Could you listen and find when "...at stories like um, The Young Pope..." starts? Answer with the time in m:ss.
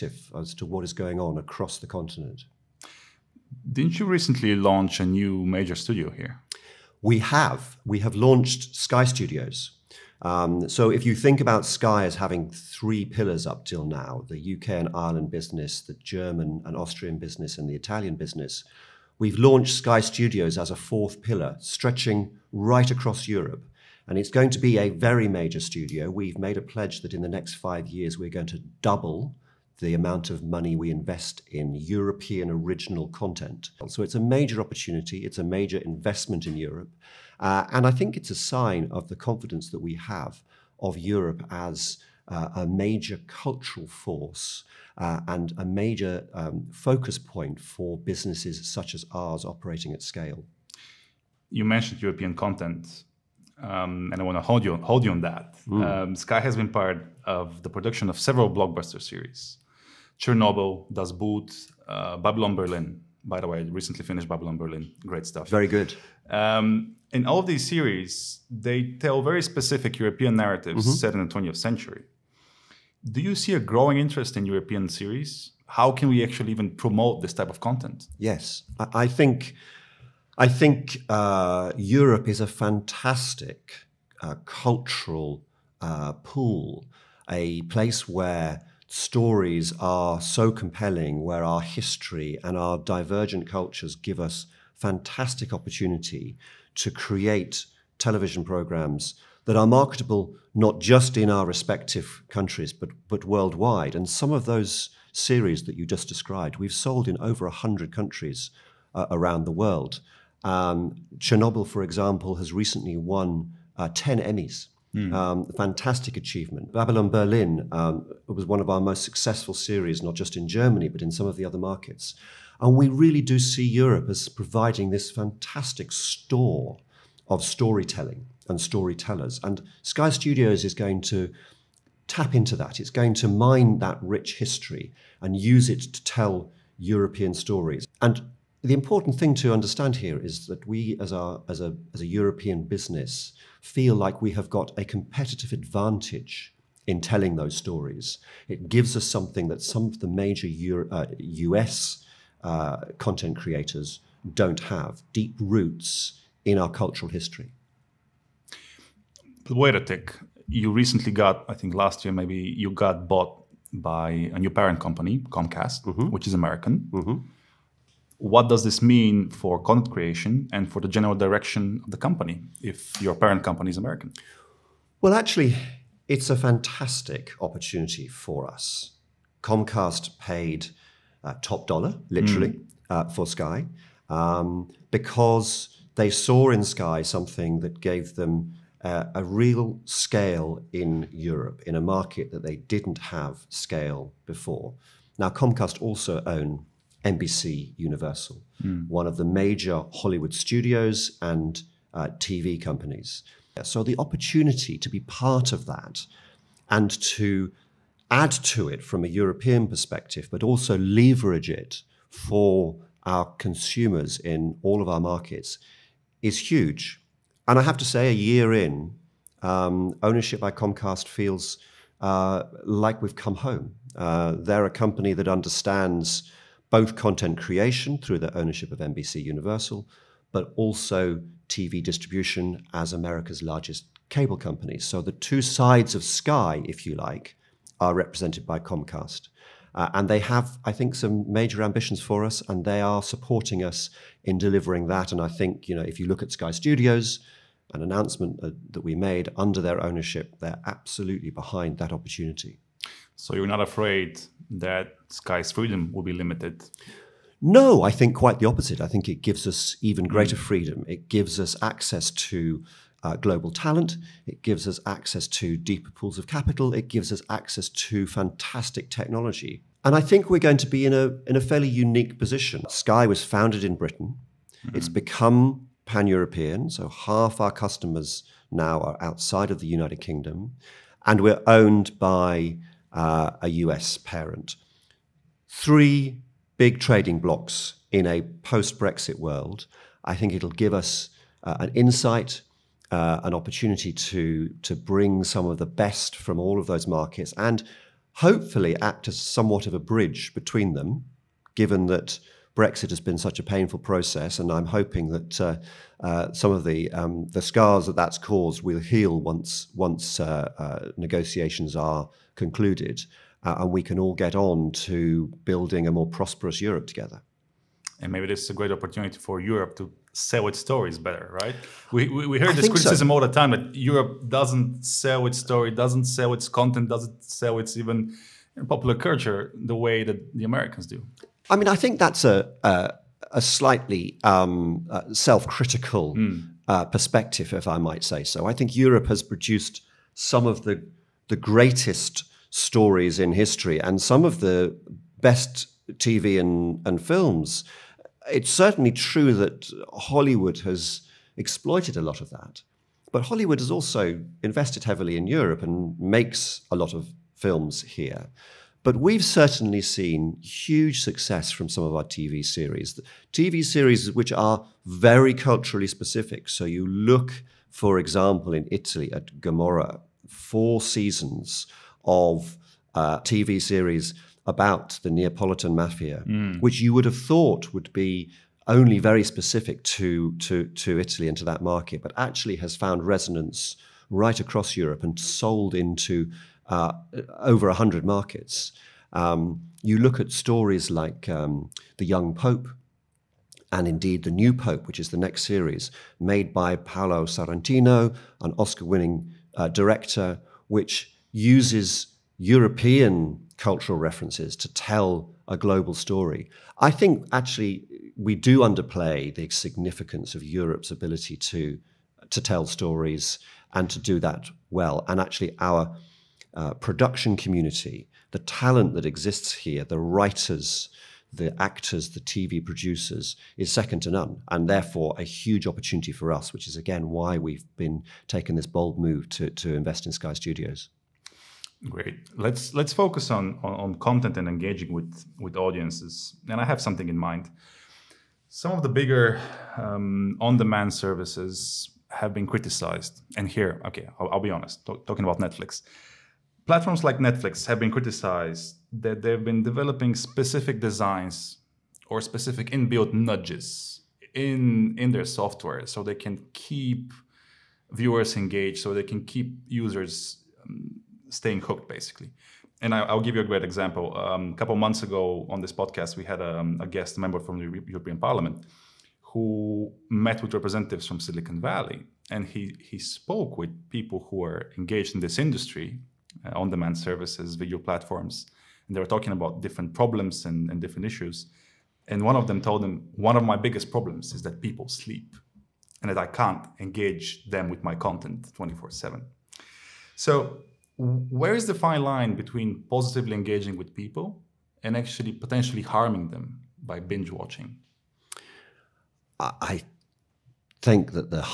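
6:30.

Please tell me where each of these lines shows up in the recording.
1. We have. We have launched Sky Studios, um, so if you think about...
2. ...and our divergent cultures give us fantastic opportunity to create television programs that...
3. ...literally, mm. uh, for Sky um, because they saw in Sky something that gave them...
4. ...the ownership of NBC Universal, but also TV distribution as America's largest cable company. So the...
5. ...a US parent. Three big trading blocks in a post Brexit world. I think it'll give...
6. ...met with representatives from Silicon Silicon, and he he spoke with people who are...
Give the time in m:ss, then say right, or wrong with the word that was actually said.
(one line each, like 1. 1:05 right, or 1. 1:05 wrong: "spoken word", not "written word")
1. 0:07 right
2. 1:32 right
3. 3:02 right
4. 3:48 right
5. 4:43 right
6. 7:50 wrong: "Valley", not "Silicon".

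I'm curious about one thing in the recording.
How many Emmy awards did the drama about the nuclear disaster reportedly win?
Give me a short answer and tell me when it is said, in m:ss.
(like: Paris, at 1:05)
10, at 1:53.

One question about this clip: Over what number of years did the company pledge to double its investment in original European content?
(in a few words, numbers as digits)
5.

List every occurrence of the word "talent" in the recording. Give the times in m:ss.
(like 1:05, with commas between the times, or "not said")
4:23, 6:58.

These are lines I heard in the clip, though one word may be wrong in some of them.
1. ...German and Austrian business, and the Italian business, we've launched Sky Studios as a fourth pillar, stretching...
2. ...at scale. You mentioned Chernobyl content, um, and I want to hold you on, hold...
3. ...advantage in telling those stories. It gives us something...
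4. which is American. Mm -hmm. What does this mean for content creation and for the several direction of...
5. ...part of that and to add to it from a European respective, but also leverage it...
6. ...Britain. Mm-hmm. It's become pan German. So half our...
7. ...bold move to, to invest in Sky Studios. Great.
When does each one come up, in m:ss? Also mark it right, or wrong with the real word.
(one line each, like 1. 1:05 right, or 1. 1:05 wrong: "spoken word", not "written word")
1. 0:15 right
2. 0:49 wrong: "European", not "Chernobyl"
3. 2:25 right
4. 2:46 wrong: "general", not "several"
5. 3:24 wrong: "perspective", not "respective"
6. 4:33 wrong: "European", not "German"
7. 7:08 right.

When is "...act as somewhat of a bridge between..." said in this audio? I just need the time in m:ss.
4:58.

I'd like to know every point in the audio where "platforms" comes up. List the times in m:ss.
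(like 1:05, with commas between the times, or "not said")
7:26, 7:57.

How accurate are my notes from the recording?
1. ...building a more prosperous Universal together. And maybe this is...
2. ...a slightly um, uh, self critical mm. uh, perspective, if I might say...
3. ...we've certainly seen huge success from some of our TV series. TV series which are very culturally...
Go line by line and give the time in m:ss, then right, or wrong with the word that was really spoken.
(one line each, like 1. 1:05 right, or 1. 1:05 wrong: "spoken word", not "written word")
1. 5:15 wrong: "Europe", not "Universal"
2. 5:33 right
3. 5:58 right.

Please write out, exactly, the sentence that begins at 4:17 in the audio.
No, I think quite the opposite.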